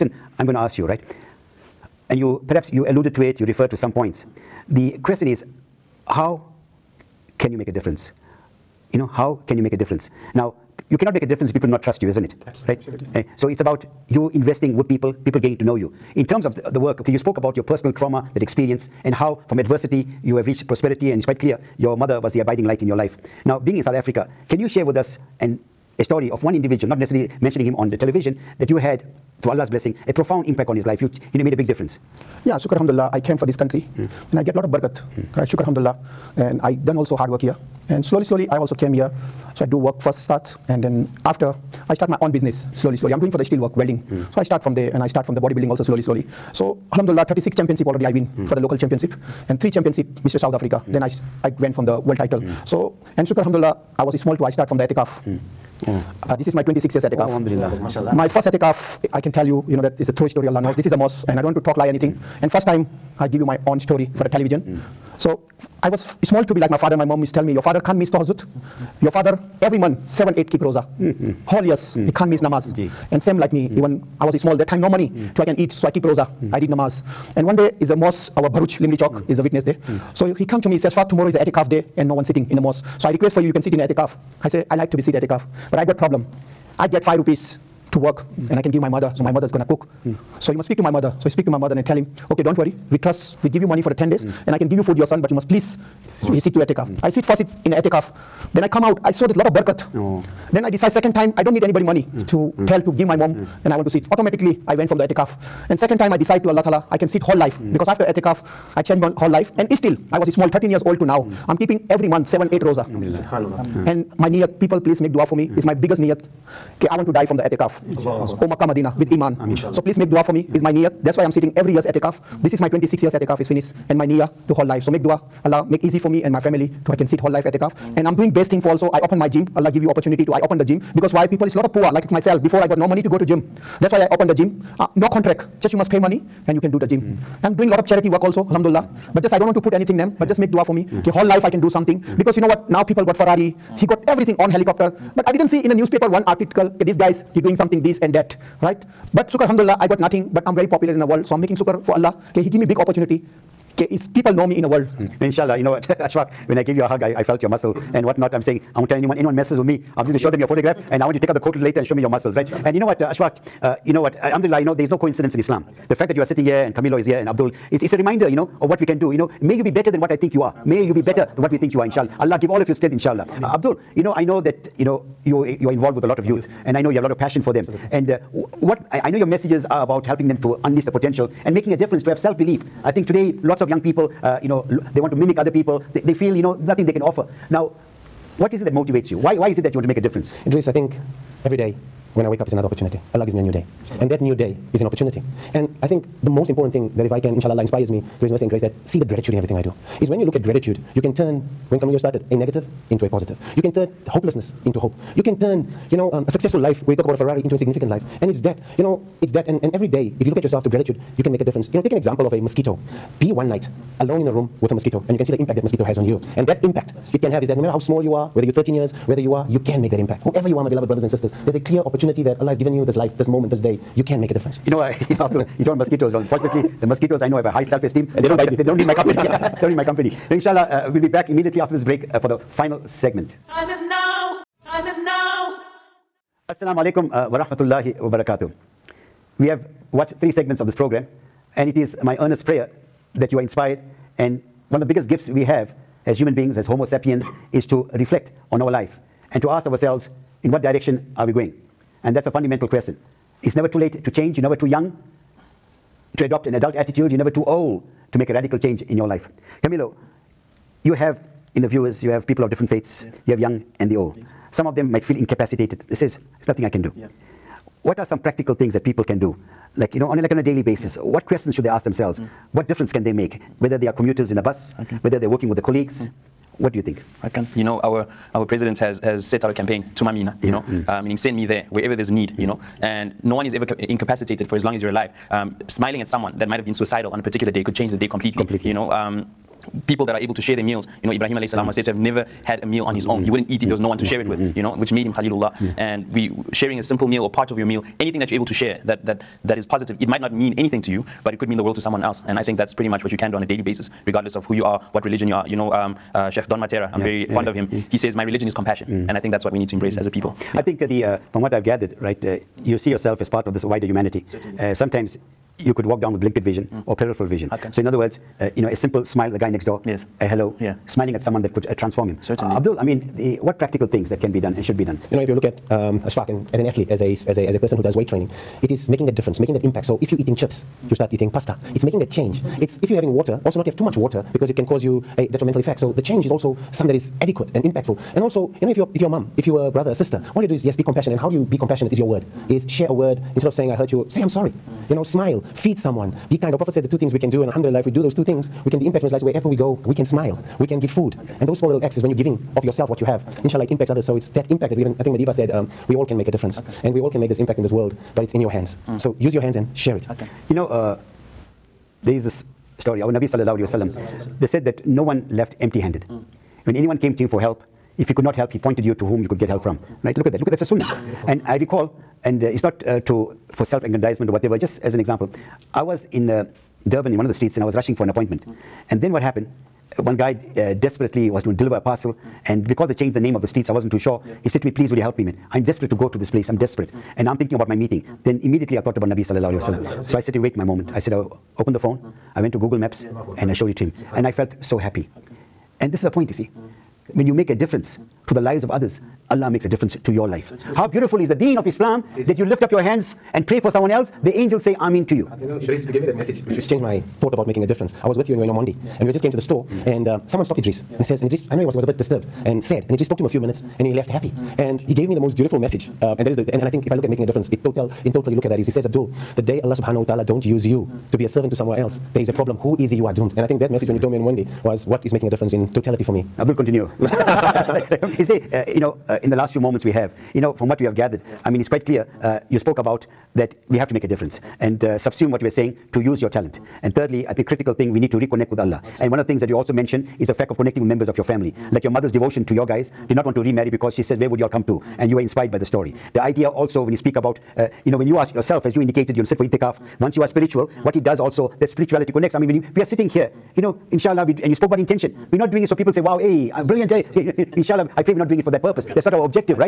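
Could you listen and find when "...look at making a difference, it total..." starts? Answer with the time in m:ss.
6:56.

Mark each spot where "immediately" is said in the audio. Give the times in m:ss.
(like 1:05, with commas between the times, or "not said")
3:51, 6:28.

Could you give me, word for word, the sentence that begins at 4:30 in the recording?
what questions should they ask themselves?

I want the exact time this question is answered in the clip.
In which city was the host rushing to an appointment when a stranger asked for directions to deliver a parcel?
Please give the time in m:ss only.
6:16.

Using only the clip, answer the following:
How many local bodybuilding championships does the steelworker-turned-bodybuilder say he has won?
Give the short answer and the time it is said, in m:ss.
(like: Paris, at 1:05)
36, at 0:47.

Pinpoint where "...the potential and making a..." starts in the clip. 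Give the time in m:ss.
3:00.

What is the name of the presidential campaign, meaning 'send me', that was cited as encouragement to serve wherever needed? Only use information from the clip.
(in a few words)
Thuma Mina.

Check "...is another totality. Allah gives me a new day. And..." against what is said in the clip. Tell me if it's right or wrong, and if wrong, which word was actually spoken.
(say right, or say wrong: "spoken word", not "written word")
wrong: "opportunity", not "totality".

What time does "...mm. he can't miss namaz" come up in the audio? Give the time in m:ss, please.
1:11.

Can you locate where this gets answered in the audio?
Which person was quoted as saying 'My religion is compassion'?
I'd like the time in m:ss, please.
5:06.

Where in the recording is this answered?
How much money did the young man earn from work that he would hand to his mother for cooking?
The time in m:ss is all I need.
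1:27.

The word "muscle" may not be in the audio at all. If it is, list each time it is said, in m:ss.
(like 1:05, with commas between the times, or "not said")
2:37, 2:42.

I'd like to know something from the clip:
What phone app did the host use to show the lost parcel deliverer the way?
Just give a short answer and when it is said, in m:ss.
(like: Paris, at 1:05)
Google Maps, at 6:32.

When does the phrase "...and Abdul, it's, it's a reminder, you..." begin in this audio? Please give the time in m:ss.
2:47.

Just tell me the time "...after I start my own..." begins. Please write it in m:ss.
0:41.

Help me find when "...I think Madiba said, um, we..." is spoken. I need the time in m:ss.
5:54.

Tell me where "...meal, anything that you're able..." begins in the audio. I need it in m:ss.
4:57.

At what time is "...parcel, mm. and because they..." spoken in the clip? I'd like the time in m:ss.
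6:21.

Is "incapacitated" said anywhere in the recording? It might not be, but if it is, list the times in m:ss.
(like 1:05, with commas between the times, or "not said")
4:25, 4:43.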